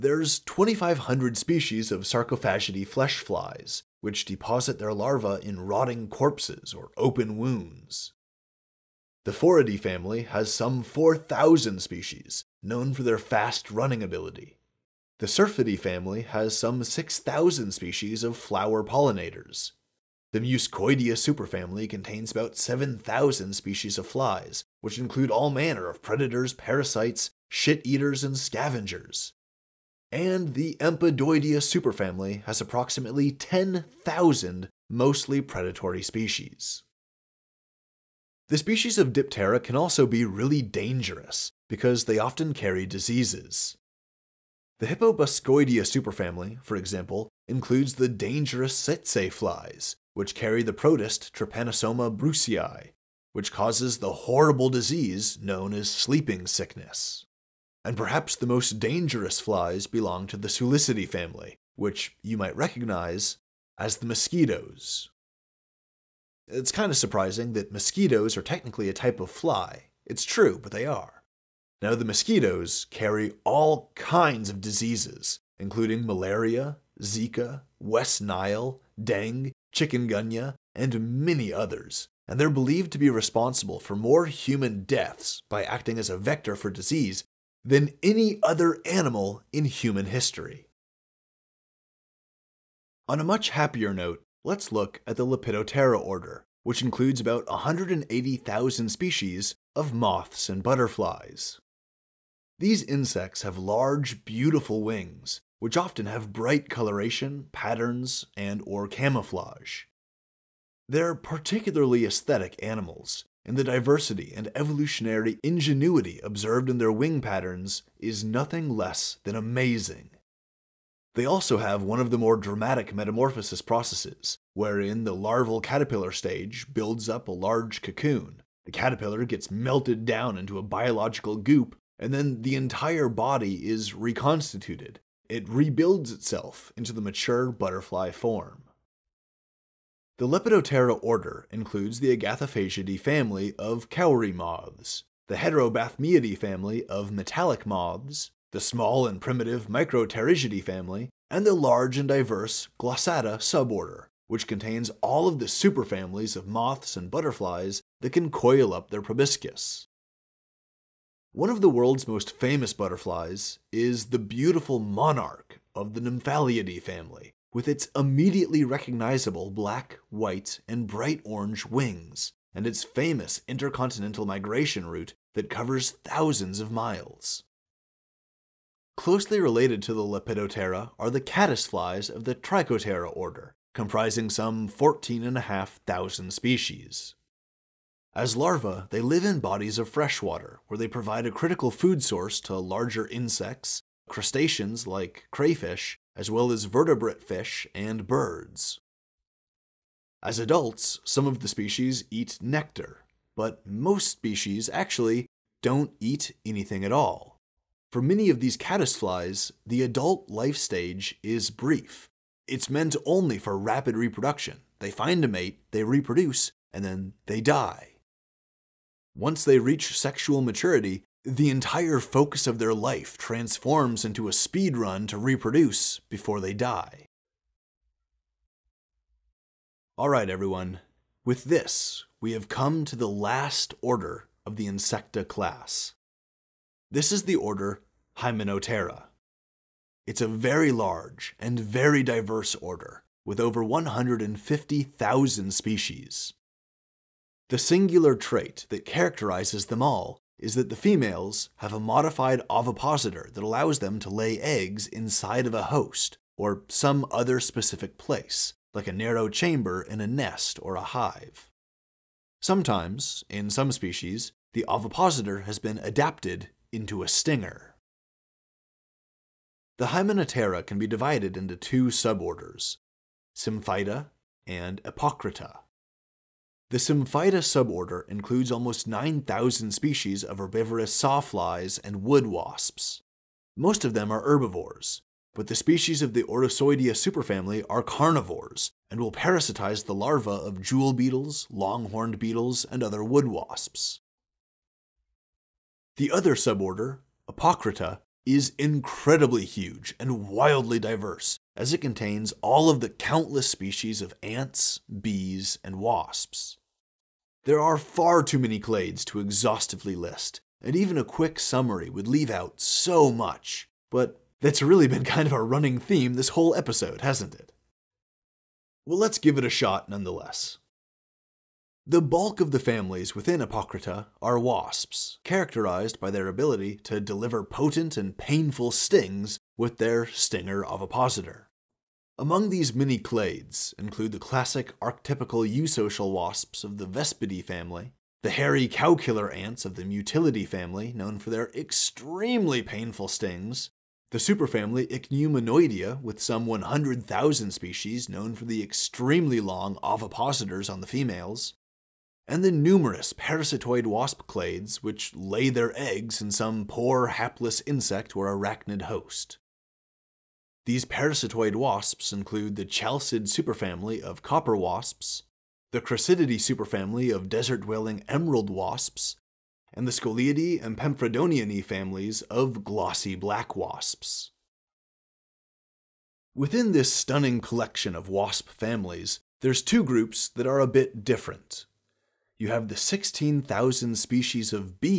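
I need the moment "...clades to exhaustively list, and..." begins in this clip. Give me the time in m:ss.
5:08.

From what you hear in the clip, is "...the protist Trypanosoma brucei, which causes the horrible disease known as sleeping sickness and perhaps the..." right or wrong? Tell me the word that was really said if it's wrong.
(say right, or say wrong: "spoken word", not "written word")
right.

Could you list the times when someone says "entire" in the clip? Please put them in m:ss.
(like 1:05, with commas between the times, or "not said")
2:12, 3:41.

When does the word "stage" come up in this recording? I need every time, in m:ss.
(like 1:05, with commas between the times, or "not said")
2:06, 3:30.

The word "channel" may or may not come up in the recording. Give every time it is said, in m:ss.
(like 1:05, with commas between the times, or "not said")
not said.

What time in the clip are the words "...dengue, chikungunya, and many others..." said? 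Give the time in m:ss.
1:19.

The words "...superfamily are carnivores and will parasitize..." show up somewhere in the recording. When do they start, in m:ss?
4:46.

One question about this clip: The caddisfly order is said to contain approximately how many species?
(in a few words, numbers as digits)
14,500.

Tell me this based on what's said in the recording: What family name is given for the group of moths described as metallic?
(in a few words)
Heterobathmiidae.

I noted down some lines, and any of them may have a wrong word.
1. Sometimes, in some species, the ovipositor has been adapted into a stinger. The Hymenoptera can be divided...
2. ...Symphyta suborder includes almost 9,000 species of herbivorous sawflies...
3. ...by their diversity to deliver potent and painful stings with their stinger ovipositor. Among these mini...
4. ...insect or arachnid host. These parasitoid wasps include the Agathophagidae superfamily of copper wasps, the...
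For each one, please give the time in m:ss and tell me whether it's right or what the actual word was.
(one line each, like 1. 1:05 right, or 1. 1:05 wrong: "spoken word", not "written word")
1. 4:22 right
2. 4:36 right
3. 5:25 wrong: "ability", not "diversity"
4. 5:57 wrong: "Chalcid", not "Agathophagidae".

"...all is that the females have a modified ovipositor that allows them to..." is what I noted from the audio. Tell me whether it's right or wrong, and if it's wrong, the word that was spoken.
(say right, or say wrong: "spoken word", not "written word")
right.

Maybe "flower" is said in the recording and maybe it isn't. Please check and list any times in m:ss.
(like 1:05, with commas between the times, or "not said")
0:18.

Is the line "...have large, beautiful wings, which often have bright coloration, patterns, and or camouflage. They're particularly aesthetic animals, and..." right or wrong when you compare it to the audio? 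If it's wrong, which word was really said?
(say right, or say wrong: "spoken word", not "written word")
right.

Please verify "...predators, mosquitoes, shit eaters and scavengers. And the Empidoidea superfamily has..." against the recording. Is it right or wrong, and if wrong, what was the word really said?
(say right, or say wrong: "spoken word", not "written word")
wrong: "parasites", not "mosquitoes".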